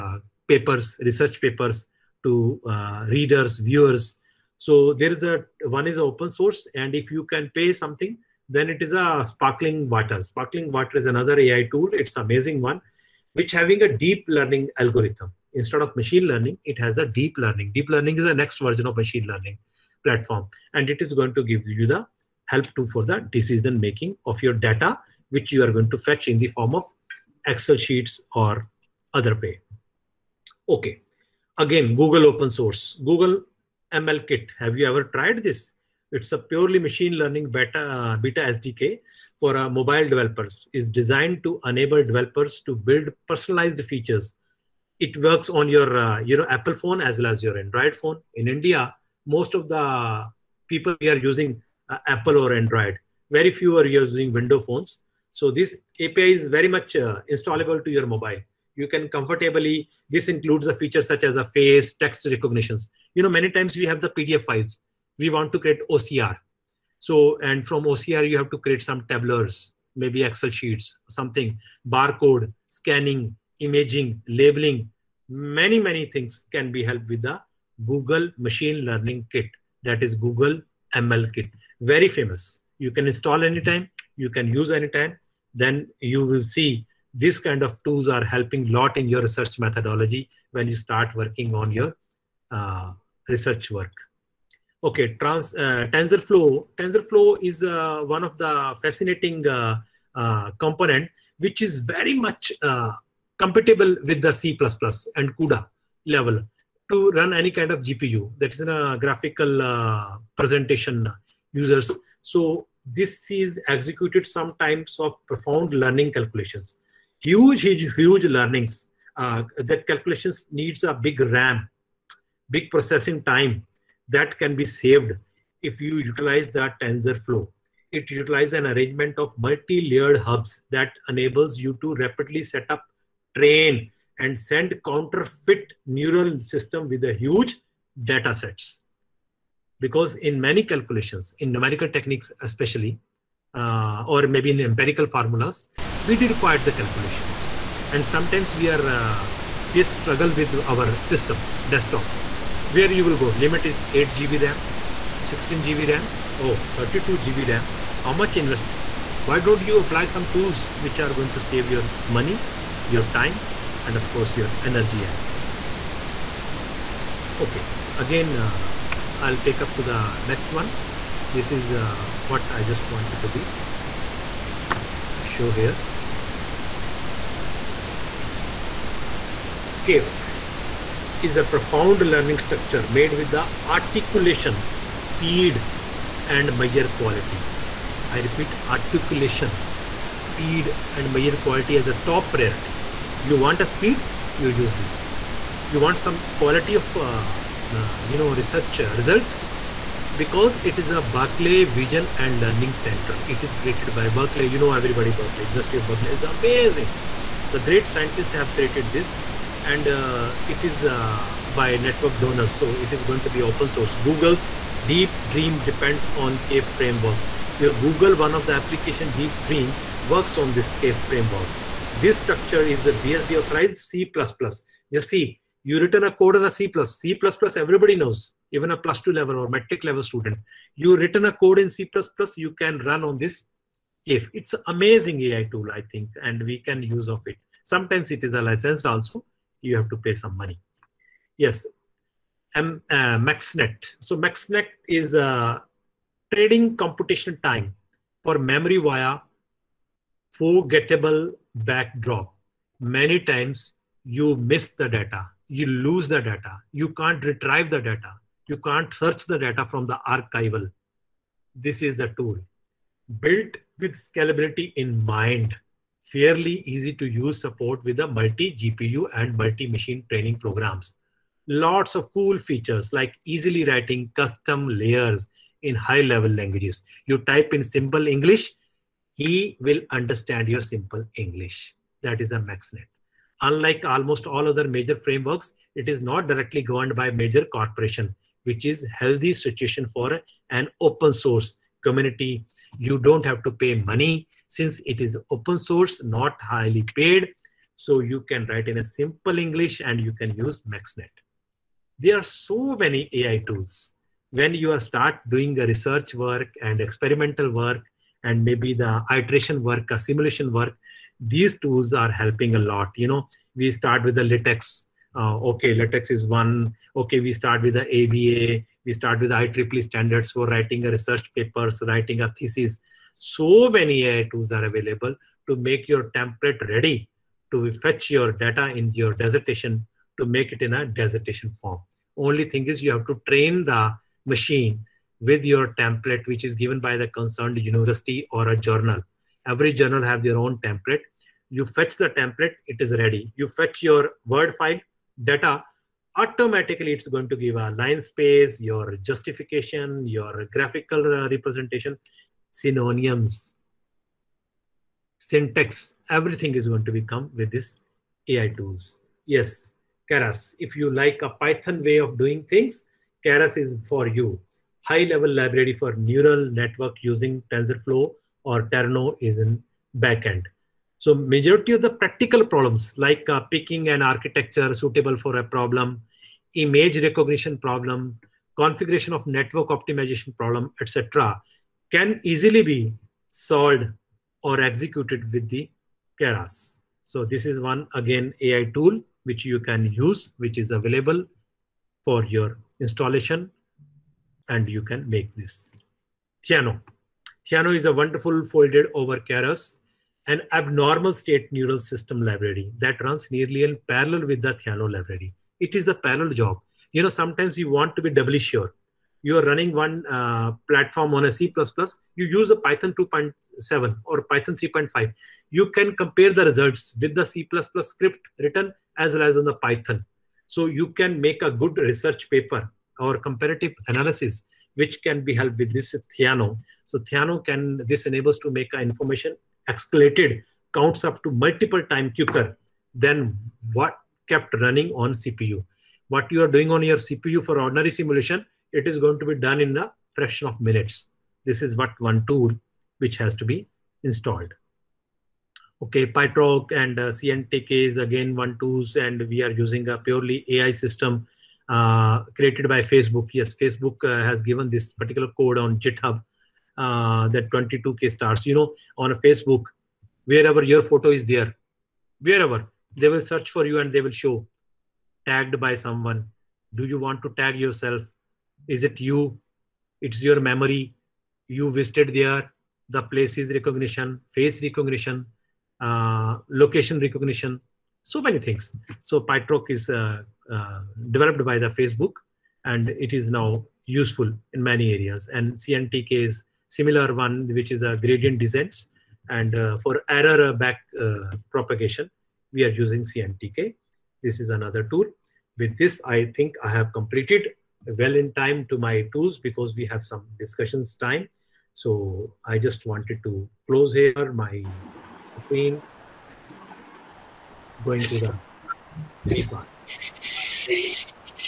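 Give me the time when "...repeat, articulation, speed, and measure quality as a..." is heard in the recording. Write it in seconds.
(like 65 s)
188 s.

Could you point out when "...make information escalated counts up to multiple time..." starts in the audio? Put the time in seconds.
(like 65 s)
428 s.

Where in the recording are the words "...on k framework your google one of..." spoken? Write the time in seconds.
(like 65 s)
216 s.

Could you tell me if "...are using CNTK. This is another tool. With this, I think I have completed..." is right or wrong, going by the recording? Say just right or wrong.
right.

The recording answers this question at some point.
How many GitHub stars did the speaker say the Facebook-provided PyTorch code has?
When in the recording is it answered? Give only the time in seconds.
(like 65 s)
457 s.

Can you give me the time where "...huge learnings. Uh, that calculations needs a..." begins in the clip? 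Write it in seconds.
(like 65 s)
117 s.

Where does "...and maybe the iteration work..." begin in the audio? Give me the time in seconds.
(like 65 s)
308 s.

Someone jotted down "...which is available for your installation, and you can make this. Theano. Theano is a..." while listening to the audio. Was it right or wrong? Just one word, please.
right.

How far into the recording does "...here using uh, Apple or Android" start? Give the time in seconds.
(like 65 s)
50 s.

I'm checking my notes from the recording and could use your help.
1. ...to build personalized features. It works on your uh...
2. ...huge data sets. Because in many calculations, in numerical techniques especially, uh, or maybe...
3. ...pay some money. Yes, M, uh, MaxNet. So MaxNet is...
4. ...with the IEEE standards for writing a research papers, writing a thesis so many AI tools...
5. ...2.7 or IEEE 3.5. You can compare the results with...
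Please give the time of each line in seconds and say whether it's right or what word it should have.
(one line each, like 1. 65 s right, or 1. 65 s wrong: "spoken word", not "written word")
1. 42 s right
2. 137 s right
3. 239 s right
4. 319 s right
5. 412 s wrong: "Python", not "IEEE".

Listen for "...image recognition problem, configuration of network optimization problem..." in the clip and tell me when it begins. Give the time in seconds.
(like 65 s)
376 s.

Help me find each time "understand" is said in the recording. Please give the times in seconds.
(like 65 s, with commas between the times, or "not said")
279 s.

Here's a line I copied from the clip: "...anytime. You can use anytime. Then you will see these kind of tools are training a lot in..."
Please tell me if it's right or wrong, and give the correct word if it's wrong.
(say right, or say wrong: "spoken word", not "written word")
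wrong: "helping", not "training".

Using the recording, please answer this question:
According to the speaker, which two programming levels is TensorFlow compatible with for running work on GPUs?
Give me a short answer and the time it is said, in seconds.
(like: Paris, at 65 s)
C++ and CUDA, at 104 s.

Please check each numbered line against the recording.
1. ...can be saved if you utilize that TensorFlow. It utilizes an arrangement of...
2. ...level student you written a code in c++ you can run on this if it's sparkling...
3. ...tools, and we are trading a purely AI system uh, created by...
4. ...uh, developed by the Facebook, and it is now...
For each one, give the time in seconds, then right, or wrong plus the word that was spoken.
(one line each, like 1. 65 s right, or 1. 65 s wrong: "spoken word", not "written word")
1. 124 s right
2. 229 s wrong: "amazing", not "sparkling"
3. 448 s wrong: "using", not "trading"
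4. 480 s right.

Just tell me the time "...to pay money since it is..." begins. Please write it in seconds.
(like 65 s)
293 s.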